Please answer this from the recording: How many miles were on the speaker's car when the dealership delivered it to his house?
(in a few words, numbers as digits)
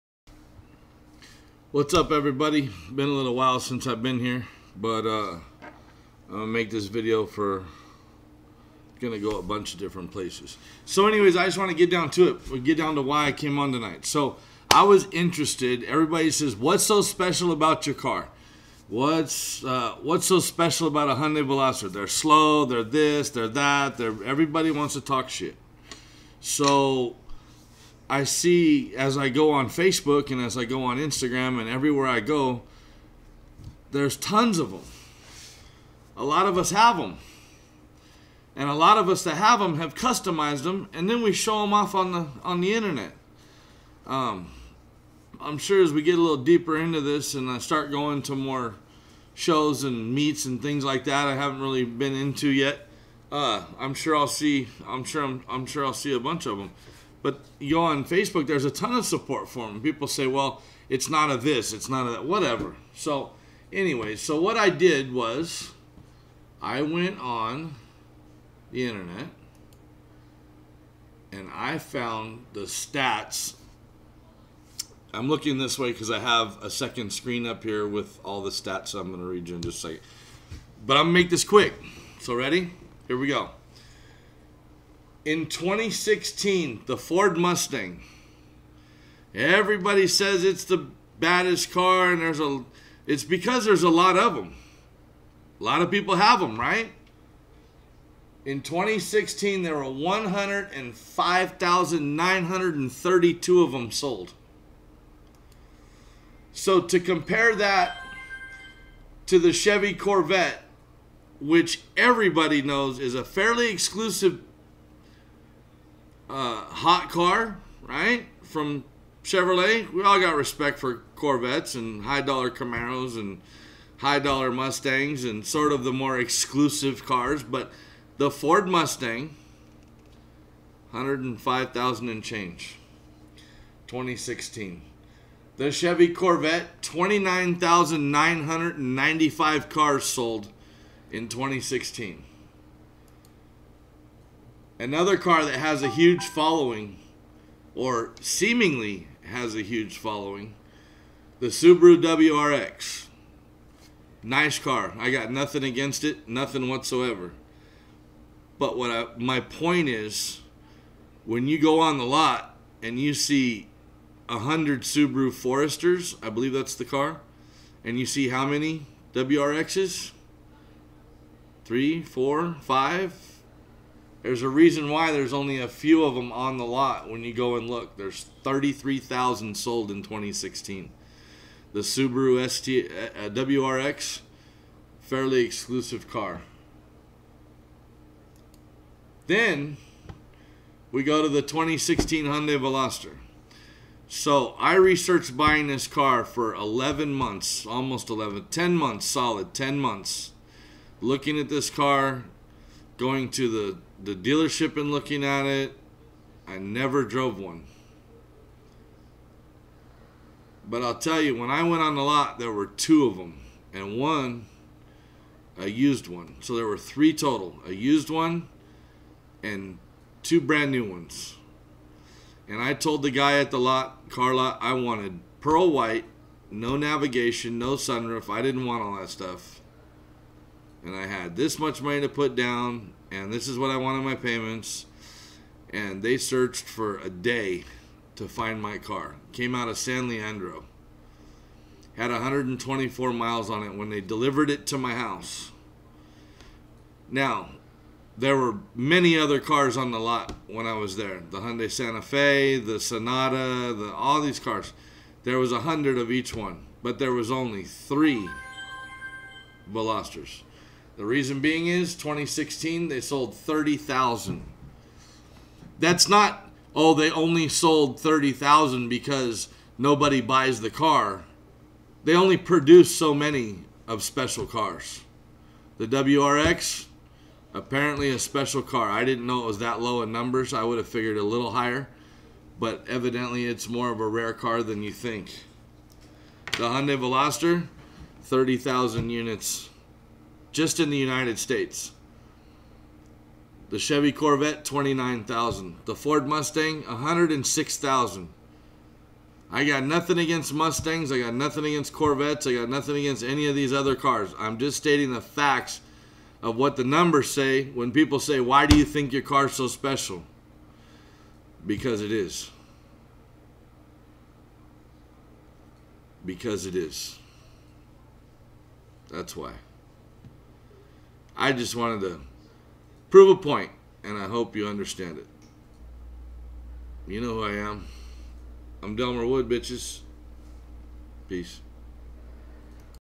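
124.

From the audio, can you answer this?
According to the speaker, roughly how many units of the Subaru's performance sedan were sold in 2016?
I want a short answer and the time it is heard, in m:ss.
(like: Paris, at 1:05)
33,000, at 2:58.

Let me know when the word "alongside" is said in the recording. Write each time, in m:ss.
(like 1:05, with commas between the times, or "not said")
not said.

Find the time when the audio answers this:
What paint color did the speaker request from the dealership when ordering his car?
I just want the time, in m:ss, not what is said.
3:45.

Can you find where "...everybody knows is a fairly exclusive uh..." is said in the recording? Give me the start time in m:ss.
1:51.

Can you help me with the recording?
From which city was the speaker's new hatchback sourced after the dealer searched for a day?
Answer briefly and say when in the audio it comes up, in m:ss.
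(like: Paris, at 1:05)
San Leandro, at 3:59.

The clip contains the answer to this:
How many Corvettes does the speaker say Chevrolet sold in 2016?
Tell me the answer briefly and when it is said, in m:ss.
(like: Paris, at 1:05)
29,995, at 2:16.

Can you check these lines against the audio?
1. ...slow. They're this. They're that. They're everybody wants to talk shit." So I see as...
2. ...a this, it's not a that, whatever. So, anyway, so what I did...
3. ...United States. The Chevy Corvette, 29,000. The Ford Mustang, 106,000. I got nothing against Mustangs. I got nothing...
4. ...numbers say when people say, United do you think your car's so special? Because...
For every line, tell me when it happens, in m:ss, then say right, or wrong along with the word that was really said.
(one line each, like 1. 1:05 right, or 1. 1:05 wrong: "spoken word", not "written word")
1. 0:22 right
2. 1:01 right
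3. 4:50 right
4. 5:06 wrong: "Why", not "United".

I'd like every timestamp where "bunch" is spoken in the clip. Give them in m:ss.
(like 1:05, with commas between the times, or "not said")
0:09, 0:56.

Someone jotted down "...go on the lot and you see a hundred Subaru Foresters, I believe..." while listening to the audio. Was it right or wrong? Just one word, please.
right.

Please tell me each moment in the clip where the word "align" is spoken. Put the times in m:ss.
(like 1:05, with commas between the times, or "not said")
not said.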